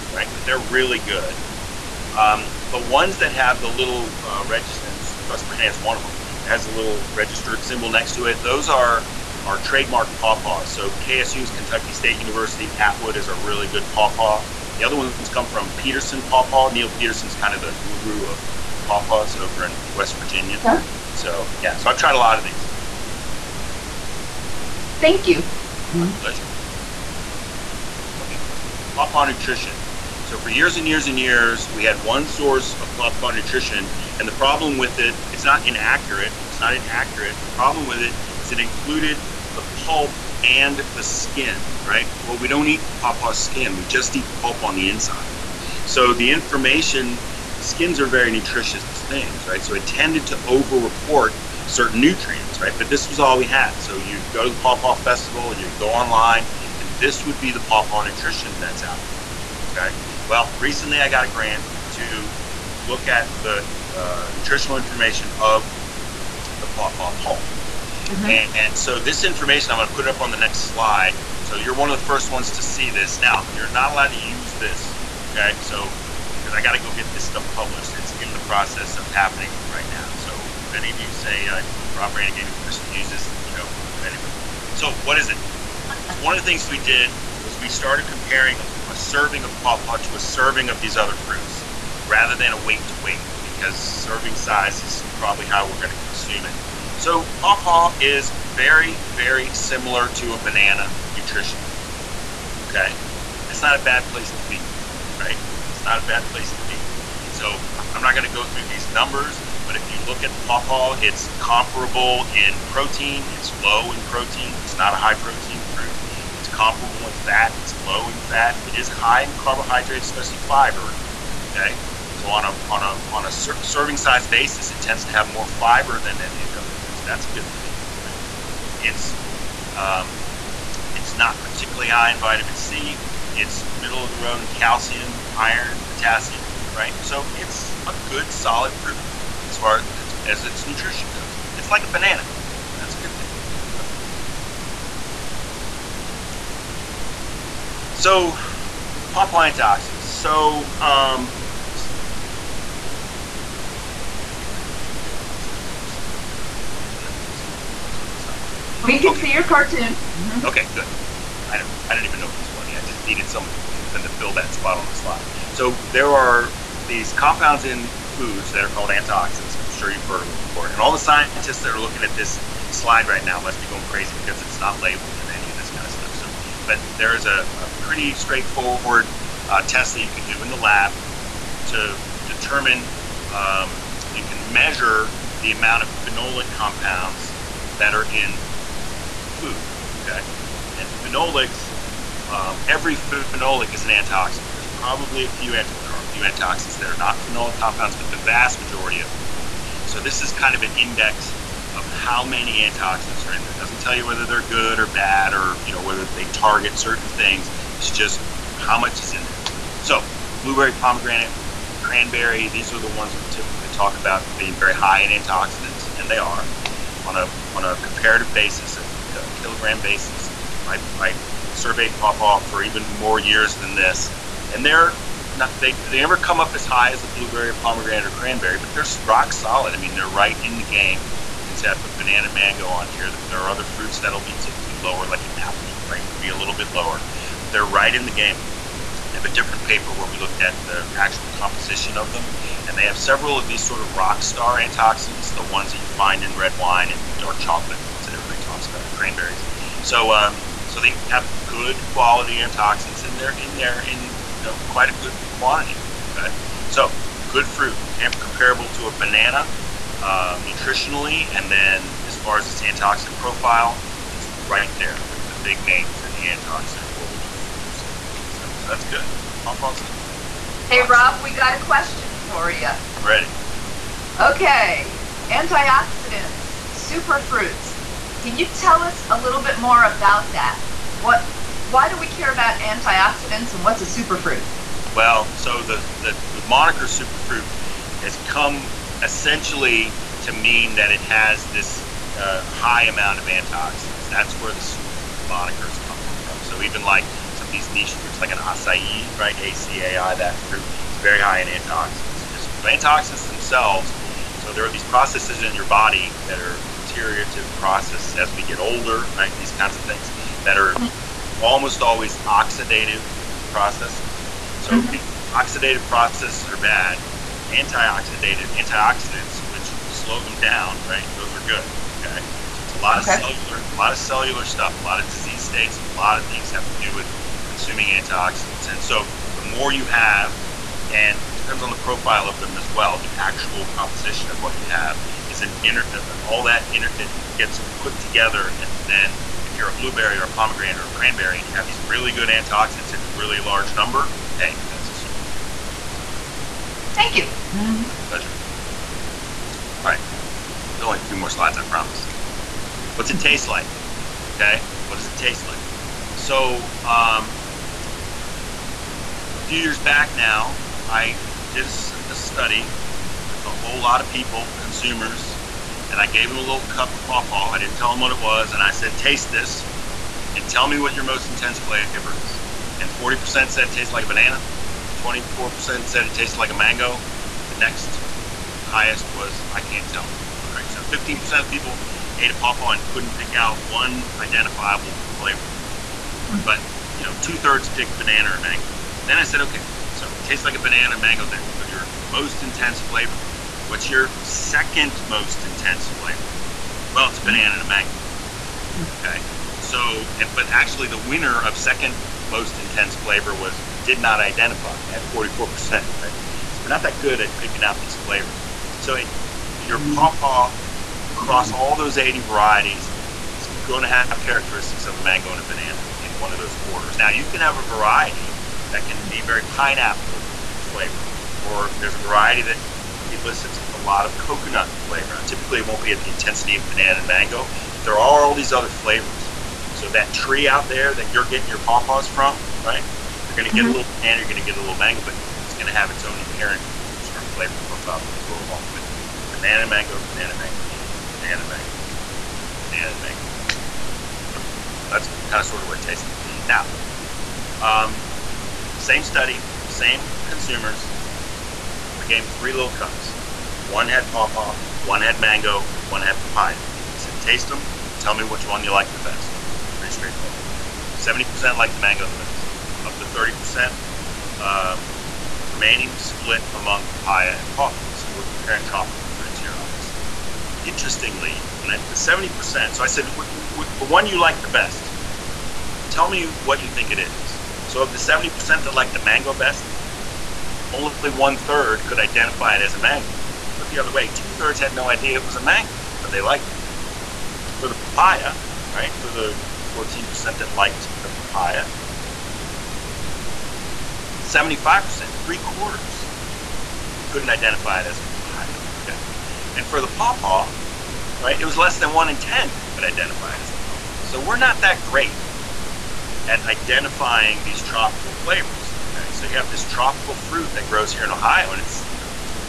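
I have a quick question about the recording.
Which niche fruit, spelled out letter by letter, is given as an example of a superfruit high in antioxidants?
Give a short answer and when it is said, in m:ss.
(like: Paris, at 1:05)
acai, at 4:58.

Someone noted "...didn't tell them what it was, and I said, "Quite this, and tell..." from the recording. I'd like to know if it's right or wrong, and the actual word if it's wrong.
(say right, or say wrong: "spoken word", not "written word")
wrong: "Taste", not "Quite".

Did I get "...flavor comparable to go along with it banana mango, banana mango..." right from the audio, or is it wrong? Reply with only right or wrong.
wrong.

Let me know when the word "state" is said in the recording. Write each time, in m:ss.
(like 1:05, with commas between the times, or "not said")
0:11, 5:25.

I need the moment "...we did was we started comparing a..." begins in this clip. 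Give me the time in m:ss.
1:26.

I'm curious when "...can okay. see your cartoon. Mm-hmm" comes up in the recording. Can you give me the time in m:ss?
2:38.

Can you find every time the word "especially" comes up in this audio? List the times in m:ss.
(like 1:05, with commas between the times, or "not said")
2:00.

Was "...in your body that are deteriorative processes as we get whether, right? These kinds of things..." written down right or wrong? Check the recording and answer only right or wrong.
wrong.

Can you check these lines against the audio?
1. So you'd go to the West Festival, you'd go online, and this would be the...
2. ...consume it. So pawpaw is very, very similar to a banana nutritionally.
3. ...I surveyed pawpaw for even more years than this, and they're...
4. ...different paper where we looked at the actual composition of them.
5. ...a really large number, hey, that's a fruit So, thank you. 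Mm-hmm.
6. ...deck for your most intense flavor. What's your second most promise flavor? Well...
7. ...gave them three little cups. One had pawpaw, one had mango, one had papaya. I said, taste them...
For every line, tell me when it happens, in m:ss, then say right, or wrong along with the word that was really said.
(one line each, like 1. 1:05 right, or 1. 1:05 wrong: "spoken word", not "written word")
1. 0:53 wrong: "Pawpaw", not "West"
2. 1:35 right
3. 3:40 right
4. 3:59 right
5. 5:43 right
6. 6:31 wrong: "intense", not "promise"
7. 7:32 right.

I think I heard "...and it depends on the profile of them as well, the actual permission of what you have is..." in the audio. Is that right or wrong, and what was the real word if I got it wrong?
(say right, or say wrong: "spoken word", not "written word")
wrong: "composition", not "permission".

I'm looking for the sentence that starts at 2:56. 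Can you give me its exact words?
So, but there is a, a pretty straightforward uh, test that you can do in the lab to determine.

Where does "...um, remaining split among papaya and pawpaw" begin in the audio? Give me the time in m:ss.
7:44.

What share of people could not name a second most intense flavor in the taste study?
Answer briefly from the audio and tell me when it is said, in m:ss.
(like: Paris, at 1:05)
44%, at 6:45.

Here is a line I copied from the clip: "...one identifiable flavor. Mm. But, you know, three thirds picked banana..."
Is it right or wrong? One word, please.
wrong.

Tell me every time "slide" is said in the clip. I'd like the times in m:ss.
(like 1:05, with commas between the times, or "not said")
1:10, 2:44, 2:52, 5:51.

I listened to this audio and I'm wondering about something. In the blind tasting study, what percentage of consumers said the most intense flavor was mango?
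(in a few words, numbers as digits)
24%.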